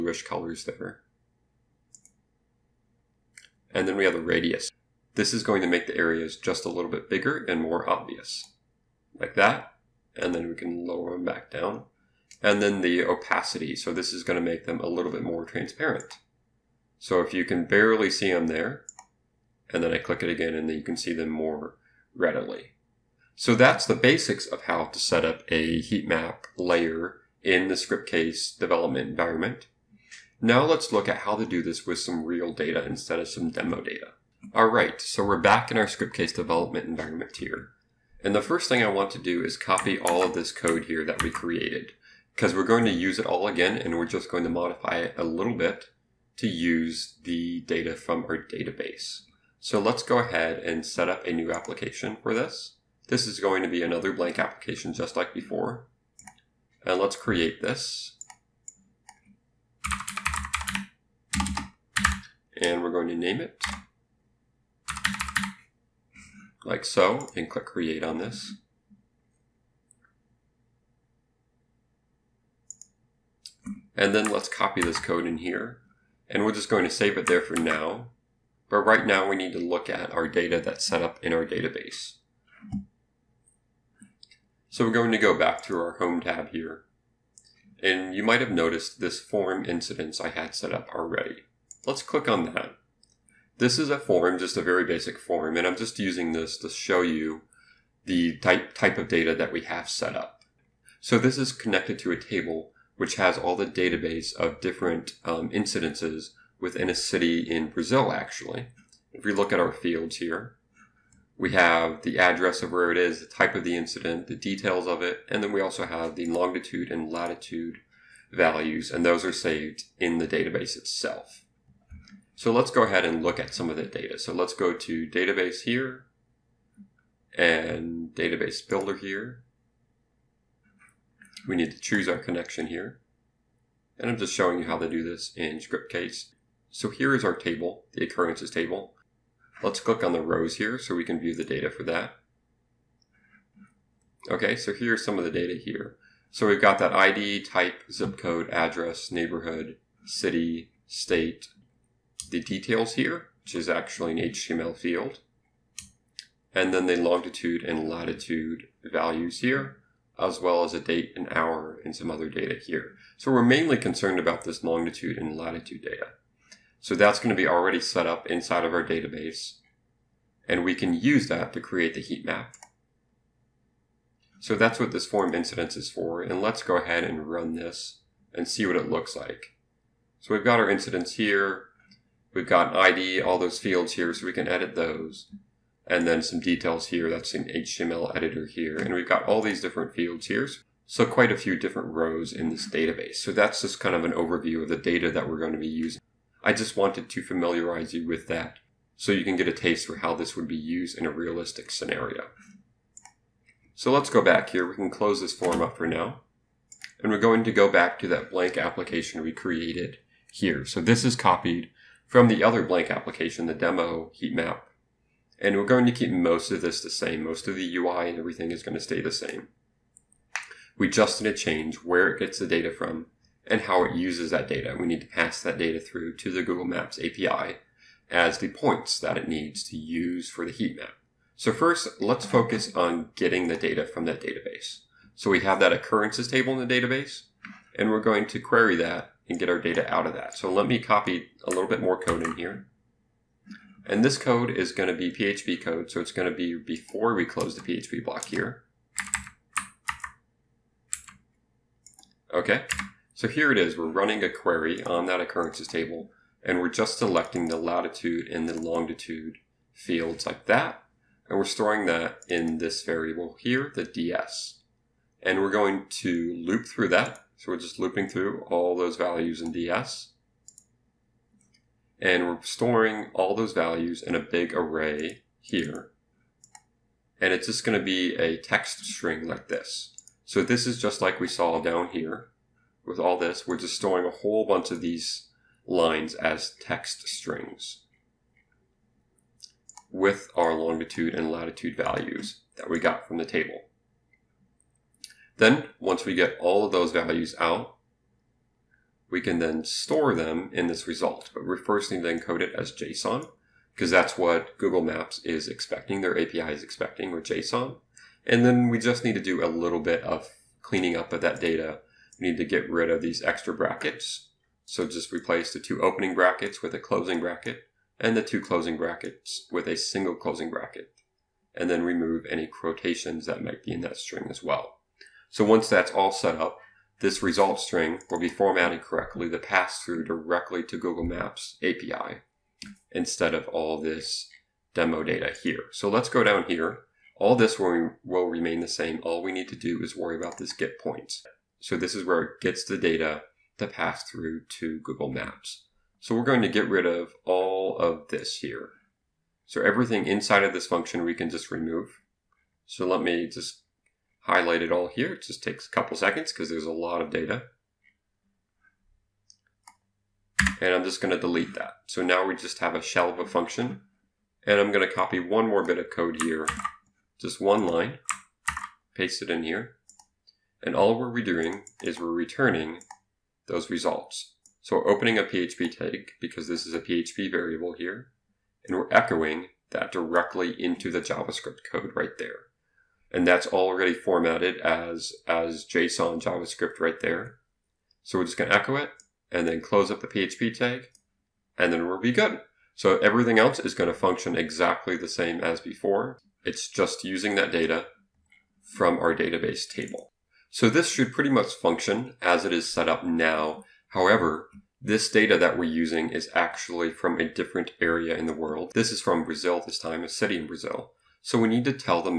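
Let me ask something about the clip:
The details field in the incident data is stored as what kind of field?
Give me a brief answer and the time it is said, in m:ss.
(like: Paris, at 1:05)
HTML field, at 2:34.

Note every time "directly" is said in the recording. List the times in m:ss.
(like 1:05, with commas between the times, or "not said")
5:30, 6:19.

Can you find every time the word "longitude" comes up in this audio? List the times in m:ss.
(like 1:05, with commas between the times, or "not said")
1:56, 2:36, 2:44, 4:18, 4:50.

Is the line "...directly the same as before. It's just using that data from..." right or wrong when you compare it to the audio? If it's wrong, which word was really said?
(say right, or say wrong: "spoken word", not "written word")
wrong: "exactly", not "directly".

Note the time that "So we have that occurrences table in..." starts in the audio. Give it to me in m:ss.
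3:55.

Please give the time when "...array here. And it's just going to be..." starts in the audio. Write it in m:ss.
4:34.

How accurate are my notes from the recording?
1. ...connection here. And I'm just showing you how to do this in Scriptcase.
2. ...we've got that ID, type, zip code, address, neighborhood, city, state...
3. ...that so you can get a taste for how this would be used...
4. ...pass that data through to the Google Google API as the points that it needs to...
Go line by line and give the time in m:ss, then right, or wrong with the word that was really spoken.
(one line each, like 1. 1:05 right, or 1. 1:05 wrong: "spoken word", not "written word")
1. 2:12 right
2. 2:26 right
3. 3:18 right
4. 3:45 wrong: "Maps", not "Google".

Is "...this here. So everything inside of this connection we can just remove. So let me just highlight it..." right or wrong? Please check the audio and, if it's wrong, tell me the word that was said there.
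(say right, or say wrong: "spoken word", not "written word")
wrong: "function", not "connection".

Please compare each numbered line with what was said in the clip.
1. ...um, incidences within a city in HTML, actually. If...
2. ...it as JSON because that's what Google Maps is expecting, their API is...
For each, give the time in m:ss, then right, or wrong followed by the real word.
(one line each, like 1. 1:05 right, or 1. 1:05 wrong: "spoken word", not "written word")
1. 1:45 wrong: "Brazil", not "HTML"
2. 5:02 right.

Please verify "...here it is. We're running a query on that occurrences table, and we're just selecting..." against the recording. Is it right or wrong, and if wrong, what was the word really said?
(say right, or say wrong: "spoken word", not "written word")
right.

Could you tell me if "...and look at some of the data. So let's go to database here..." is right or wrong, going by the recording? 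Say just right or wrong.
right.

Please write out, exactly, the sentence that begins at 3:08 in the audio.
And we've got all these different fields here.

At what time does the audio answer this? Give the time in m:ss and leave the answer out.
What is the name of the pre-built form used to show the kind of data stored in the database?
1:29.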